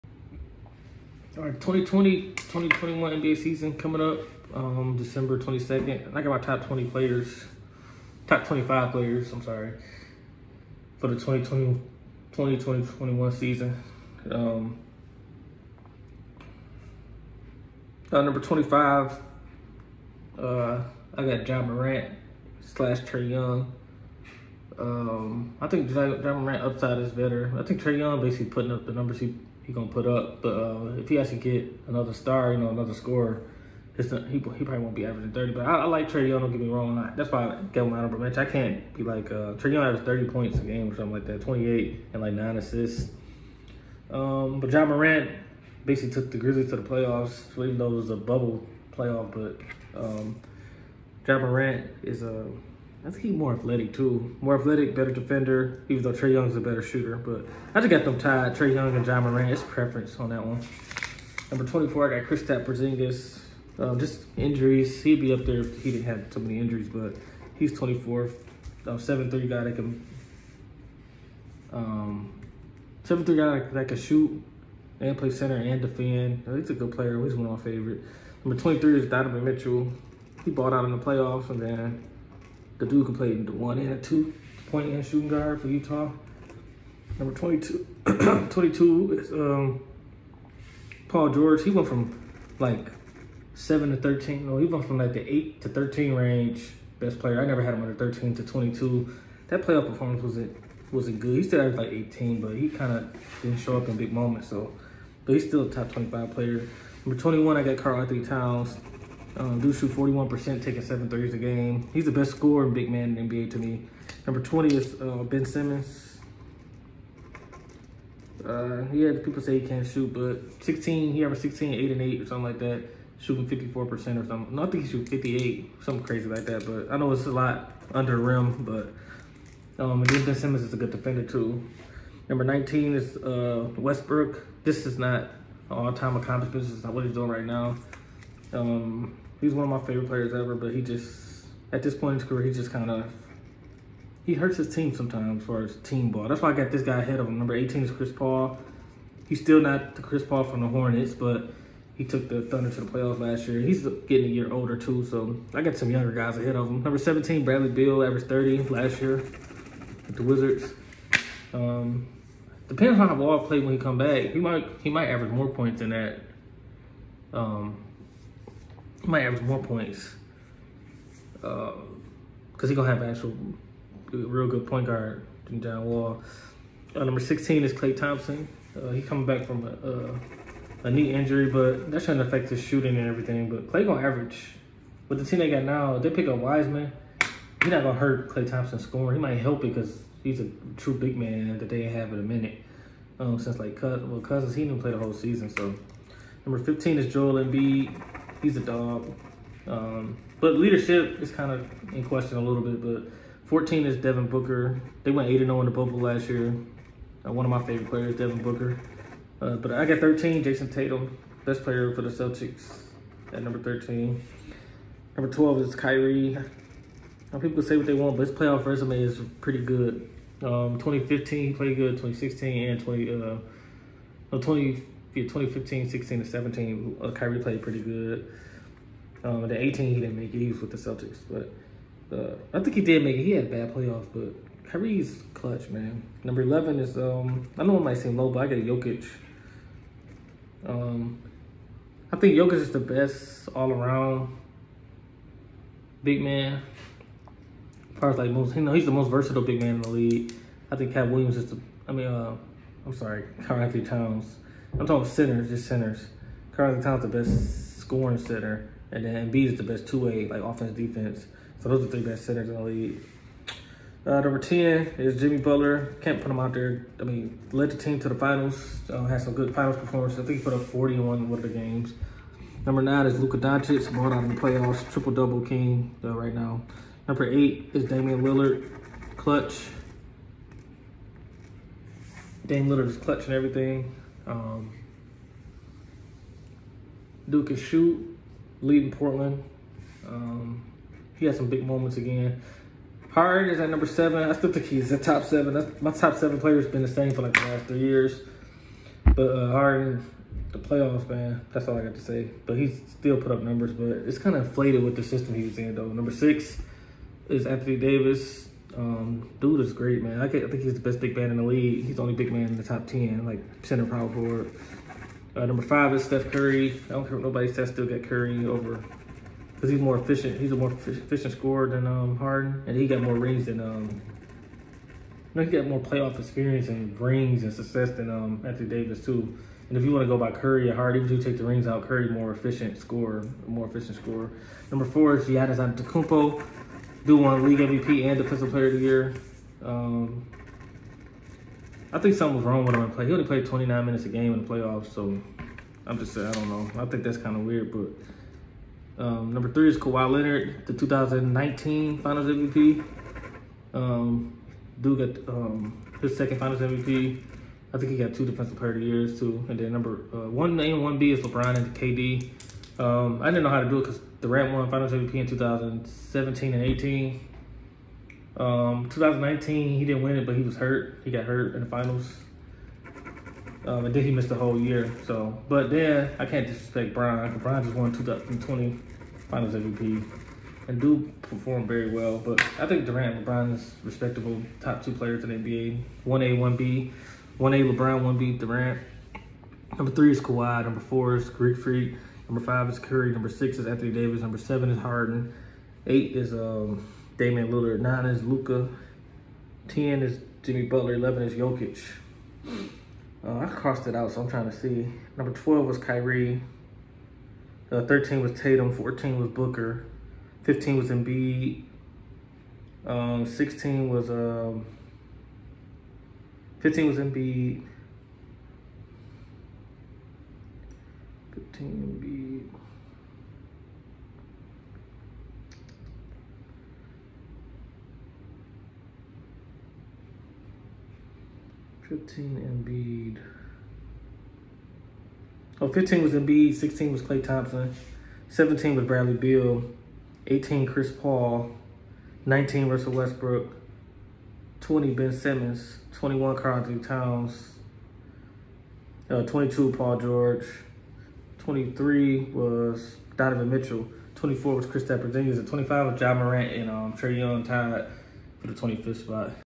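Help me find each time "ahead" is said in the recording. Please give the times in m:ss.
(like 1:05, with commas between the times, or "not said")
2:27, 2:36.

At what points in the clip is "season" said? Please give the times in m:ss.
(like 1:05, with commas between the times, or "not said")
0:03, 0:13, 3:15.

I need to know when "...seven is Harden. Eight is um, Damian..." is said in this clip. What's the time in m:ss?
6:34.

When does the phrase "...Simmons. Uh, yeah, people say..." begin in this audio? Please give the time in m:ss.
1:55.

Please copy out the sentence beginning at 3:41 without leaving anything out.
2016 and 20, uh, 20, 2015, 16, and 17, uh, Kyrie played pretty good.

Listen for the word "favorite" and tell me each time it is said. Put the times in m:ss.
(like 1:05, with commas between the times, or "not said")
1:17, 2:19, 3:27.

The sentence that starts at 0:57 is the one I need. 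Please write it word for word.
But I just got them tied, Trae Young and Ja Moran.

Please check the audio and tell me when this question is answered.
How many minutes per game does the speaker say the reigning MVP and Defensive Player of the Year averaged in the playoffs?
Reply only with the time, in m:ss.
5:43.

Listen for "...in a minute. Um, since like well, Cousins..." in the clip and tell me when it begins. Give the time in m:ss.
3:12.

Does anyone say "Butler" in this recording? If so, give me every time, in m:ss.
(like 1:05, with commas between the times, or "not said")
4:25, 6:40.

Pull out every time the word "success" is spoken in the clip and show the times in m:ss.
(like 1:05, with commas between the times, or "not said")
5:27.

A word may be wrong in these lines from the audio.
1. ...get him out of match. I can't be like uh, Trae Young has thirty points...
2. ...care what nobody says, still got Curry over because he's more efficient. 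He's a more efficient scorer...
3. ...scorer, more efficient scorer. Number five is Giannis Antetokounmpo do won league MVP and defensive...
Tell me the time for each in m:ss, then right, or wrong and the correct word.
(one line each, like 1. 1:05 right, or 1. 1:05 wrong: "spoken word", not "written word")
1. 0:37 right
2. 5:17 right
3. 5:32 wrong: "four", not "five".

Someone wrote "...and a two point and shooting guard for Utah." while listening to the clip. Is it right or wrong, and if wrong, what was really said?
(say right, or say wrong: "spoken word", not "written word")
right.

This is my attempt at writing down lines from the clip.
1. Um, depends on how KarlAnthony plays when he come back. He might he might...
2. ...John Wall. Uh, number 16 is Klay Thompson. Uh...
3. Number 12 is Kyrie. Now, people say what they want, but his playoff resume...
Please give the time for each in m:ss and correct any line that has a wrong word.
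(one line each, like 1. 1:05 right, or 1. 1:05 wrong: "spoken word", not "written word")
1. 2:41 wrong: "Wall", not "KarlAnthony"
2. 2:55 right
3. 3:35 right.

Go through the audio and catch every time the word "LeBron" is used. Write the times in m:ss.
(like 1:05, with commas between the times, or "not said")
6:01, 6:23, 6:27.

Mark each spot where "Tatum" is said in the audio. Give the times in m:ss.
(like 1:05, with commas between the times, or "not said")
3:30, 6:48.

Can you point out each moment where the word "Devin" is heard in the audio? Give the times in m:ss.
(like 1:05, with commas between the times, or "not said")
3:23, 3:28.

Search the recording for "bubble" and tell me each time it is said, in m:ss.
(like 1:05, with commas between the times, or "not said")
0:48, 3:25.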